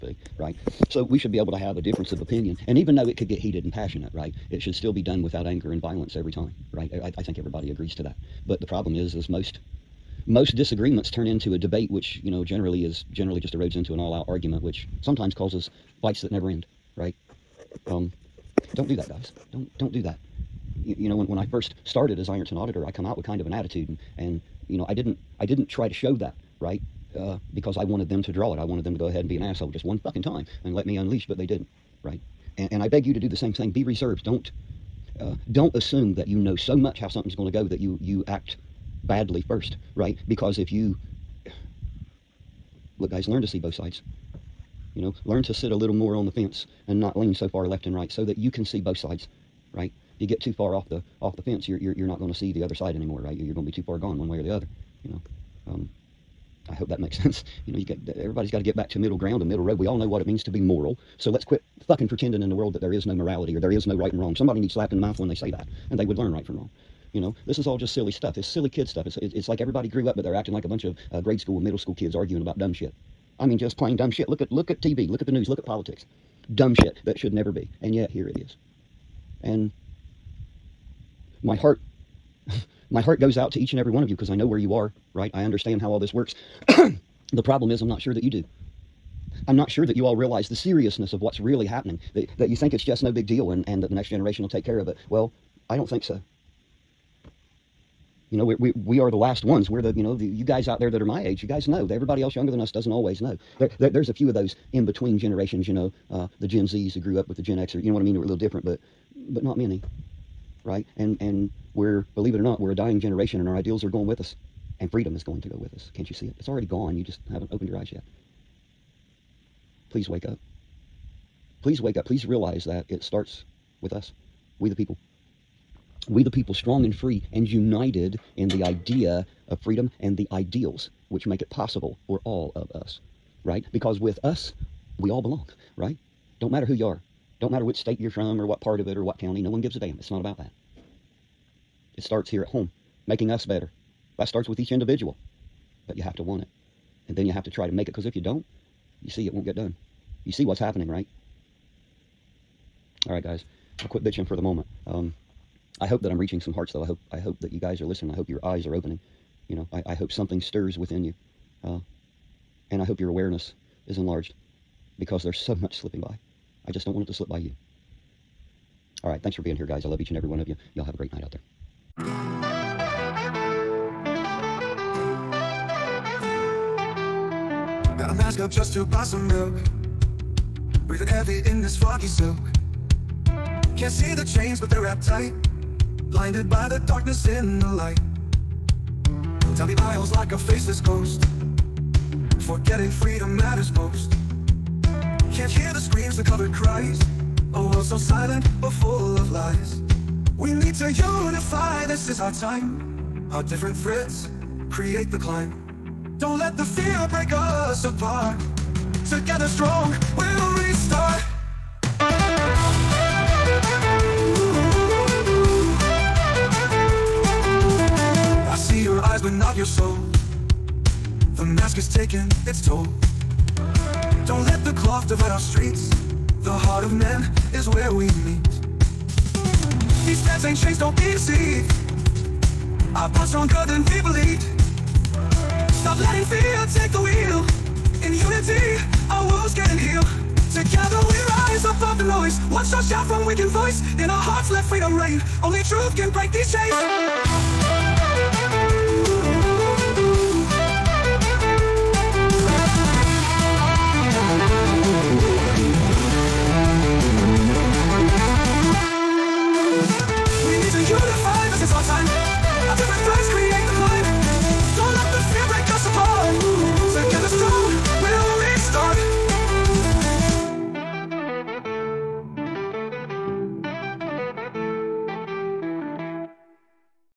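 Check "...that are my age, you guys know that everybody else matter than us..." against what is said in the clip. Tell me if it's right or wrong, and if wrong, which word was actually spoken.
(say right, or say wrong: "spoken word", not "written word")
wrong: "younger", not "matter".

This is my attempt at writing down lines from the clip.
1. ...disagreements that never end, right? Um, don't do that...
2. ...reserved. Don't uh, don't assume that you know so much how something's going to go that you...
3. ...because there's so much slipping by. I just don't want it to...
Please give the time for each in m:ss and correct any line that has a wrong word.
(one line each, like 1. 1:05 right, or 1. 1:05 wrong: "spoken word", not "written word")
1. 0:16 wrong: "fights", not "disagreements"
2. 0:33 right
3. 2:45 right.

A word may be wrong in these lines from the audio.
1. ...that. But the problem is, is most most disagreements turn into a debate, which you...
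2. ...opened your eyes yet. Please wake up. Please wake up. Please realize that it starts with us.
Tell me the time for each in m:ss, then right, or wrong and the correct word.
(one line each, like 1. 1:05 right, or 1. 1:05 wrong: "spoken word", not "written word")
1. 0:08 right
2. 1:57 right.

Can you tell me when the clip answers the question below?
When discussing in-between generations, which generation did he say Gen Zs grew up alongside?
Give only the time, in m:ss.
1:47.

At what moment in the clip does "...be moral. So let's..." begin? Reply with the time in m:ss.
1:00.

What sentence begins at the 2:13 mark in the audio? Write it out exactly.
Because with us, we all belong, right?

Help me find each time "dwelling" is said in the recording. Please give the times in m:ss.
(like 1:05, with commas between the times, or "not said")
not said.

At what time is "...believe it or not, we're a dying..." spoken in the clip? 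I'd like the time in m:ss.
1:52.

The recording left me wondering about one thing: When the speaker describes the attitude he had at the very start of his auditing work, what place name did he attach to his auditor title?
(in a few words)
Ironton.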